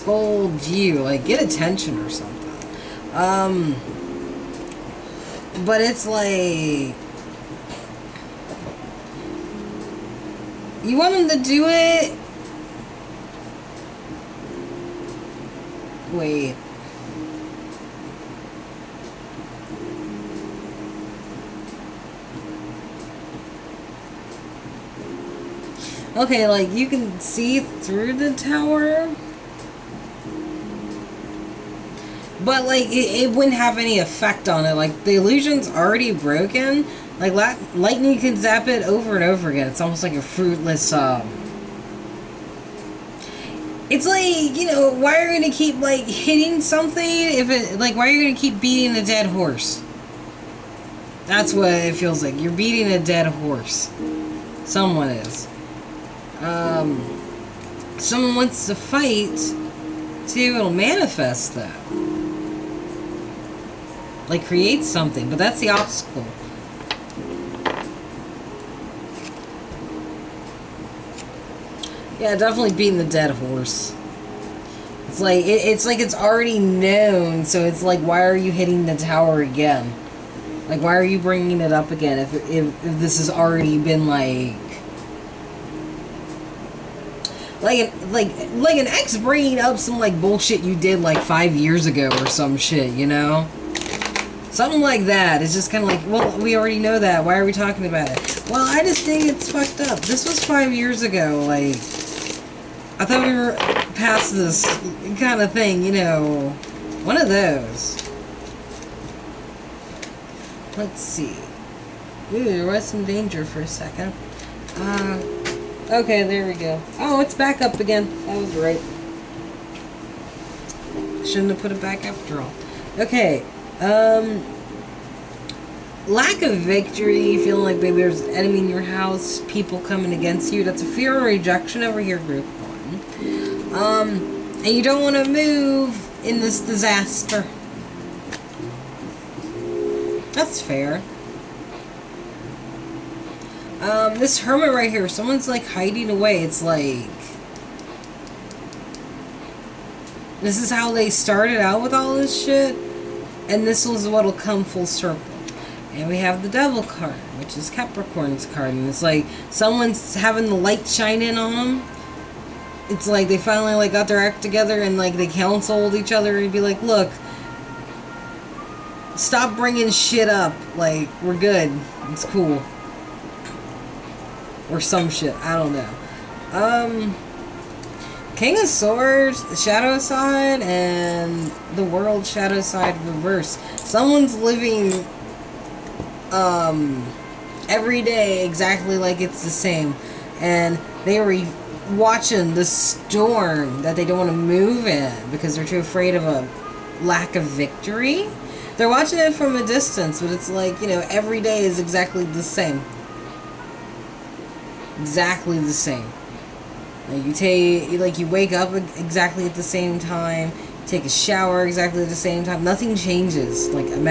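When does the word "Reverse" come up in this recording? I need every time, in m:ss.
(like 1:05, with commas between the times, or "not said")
3:03.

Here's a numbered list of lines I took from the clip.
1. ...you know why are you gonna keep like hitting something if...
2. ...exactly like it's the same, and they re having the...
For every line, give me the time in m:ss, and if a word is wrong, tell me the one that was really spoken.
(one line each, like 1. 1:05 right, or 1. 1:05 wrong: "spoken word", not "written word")
1. 0:44 right
2. 3:08 wrong: "watching", not "having".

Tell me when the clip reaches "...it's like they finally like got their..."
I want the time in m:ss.
2:42.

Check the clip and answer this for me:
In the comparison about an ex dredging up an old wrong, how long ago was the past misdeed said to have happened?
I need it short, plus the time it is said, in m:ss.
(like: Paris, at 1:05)
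5 years ago, at 1:30.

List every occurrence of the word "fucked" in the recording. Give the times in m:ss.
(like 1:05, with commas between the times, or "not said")
1:39.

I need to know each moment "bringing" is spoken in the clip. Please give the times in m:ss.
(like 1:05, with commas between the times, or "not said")
1:21, 1:29, 2:49.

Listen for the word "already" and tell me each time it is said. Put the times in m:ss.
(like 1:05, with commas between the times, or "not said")
0:35, 1:16, 1:23, 1:36.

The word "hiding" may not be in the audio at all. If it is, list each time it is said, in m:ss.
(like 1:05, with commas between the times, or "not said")
2:25.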